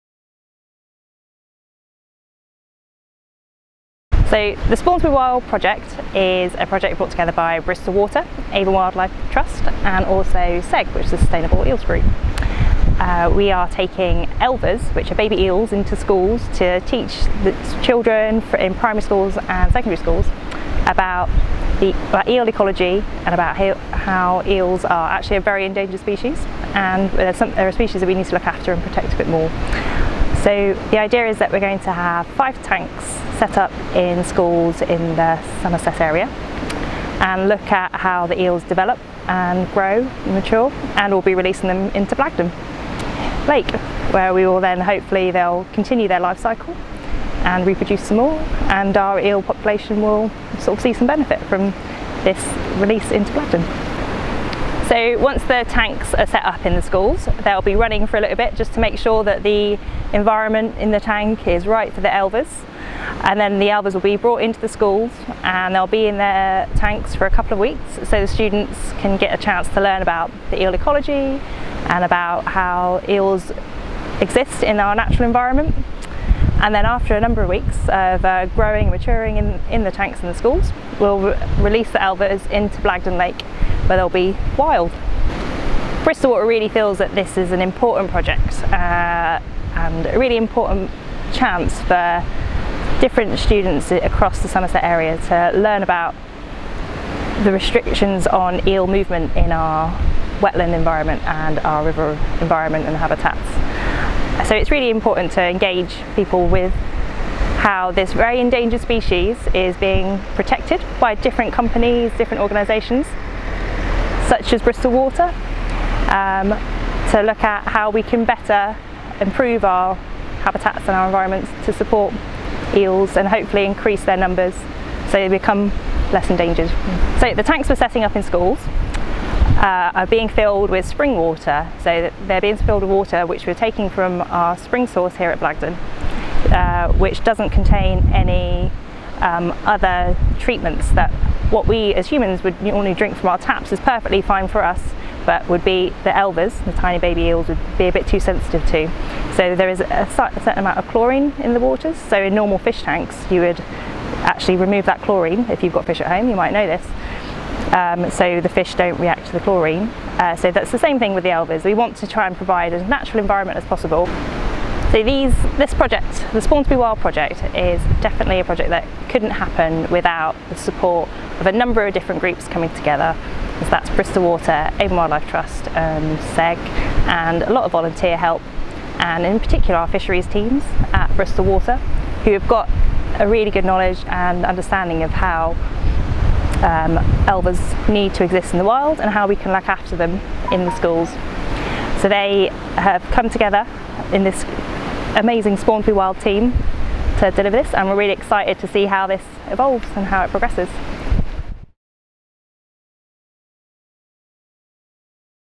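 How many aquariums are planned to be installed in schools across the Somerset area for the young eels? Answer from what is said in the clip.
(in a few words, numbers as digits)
5.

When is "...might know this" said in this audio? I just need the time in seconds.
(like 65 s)
156 s.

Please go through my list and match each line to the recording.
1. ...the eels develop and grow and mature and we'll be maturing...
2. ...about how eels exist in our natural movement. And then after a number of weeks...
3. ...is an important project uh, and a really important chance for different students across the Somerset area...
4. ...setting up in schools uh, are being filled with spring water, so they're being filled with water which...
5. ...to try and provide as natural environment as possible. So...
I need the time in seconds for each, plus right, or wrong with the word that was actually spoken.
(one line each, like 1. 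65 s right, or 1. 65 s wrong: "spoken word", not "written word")
1. 38 s wrong: "releasing", not "maturing"
2. 72 s wrong: "environment", not "movement"
3. 87 s right
4. 127 s right
5. 161 s right.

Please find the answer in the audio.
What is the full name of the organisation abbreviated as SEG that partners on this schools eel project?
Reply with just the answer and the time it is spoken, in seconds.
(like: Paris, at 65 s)
Sustainable Eels Group, at 11 s.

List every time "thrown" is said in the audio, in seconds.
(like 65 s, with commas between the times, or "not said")
not said.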